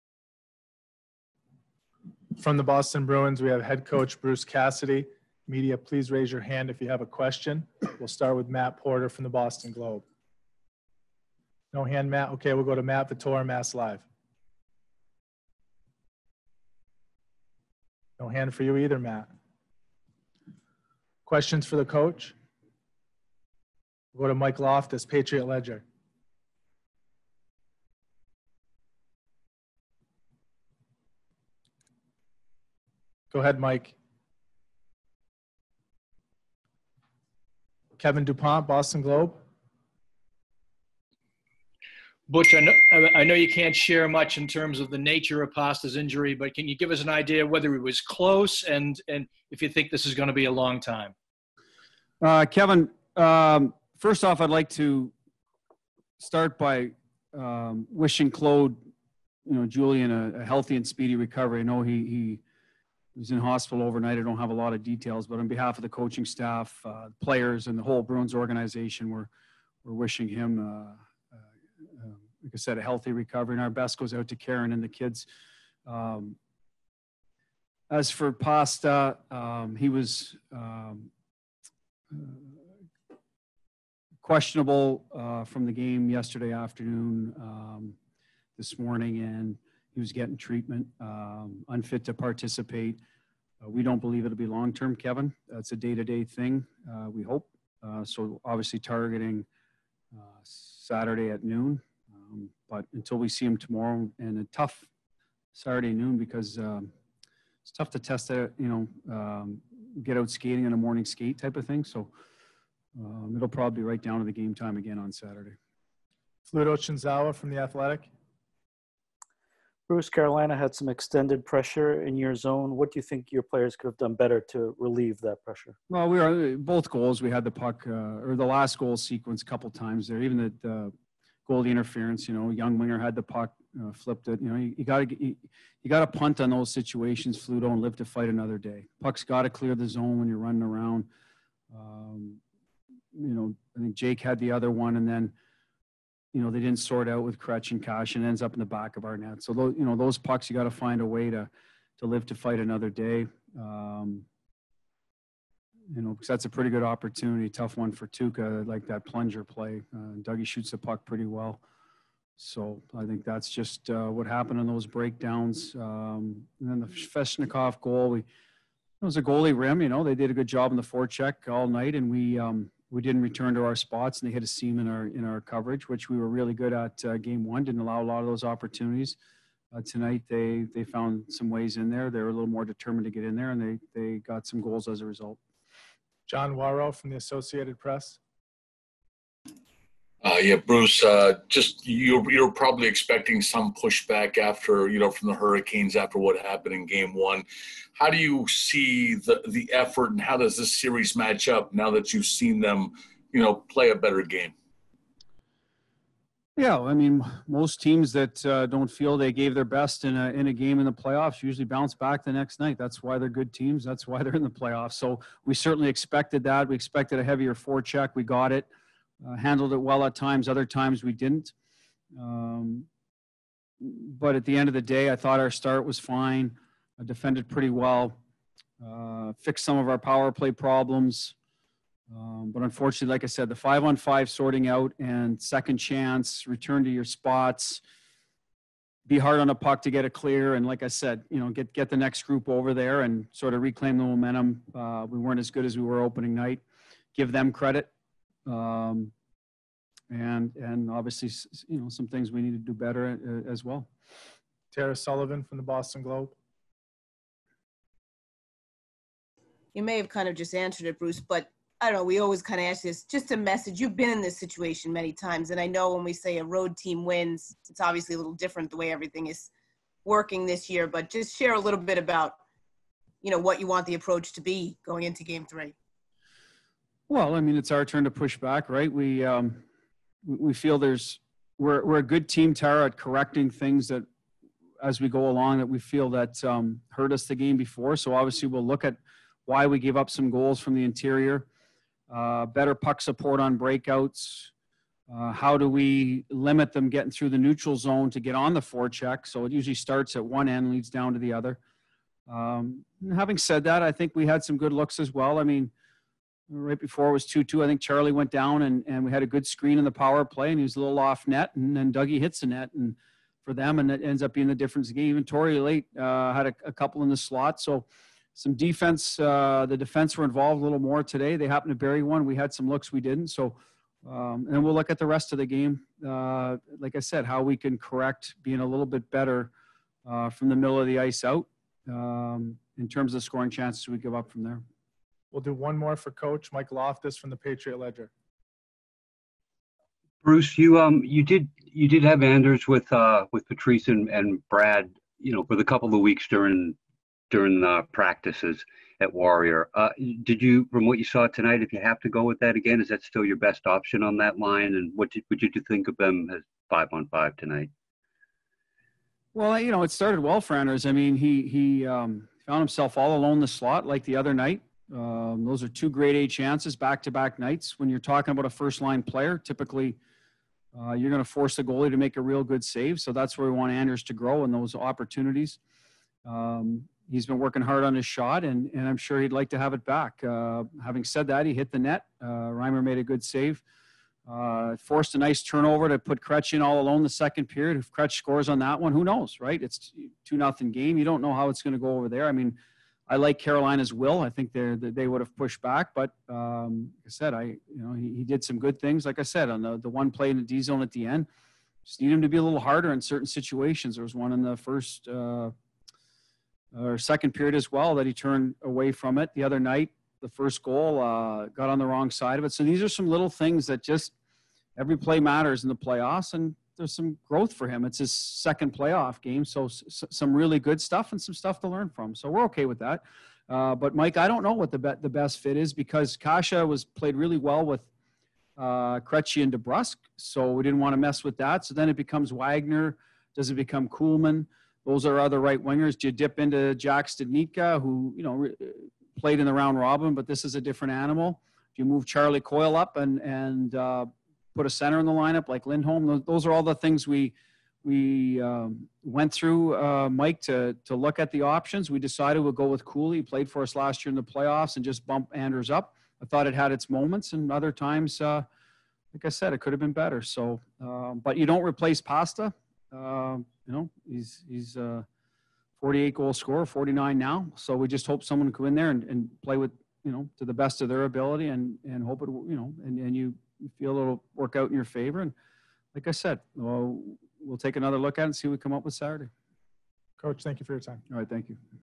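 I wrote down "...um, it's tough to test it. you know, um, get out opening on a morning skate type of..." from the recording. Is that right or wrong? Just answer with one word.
wrong.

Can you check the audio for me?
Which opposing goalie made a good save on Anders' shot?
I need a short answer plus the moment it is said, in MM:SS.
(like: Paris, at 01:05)
Reimer, at 06:22.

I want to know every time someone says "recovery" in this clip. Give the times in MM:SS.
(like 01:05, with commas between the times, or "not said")
01:01, 01:13.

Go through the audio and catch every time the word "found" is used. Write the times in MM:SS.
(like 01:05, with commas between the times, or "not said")
03:00, 06:02.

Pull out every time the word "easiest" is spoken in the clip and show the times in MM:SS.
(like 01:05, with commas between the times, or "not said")
not said.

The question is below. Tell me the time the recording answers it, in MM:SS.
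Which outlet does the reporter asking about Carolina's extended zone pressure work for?
01:57.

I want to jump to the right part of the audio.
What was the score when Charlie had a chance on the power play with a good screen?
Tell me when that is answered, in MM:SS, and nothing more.
05:07.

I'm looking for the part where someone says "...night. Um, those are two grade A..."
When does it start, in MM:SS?
06:04.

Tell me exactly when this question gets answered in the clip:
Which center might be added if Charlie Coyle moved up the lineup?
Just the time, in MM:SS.
07:25.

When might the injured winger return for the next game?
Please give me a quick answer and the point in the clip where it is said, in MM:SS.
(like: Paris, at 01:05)
Saturday at noon, at 01:40.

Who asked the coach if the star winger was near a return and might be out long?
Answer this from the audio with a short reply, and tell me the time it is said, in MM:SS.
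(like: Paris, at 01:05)
Kevin DuPont, at 00:37.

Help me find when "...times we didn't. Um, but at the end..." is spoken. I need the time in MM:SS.
03:40.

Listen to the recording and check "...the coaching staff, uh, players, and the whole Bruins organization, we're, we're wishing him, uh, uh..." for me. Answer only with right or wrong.
right.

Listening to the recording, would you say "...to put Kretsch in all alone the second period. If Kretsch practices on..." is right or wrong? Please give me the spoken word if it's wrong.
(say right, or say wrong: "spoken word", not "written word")
wrong: "scores", not "practices".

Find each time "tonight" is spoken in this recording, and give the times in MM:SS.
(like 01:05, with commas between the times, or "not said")
02:59, 05:51, 05:57.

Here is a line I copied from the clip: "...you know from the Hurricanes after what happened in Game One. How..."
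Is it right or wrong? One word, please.
right.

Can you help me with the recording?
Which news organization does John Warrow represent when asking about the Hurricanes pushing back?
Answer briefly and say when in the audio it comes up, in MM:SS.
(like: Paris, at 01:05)
Associated Press, at 03:07.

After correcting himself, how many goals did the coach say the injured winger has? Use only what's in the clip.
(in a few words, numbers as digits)
49.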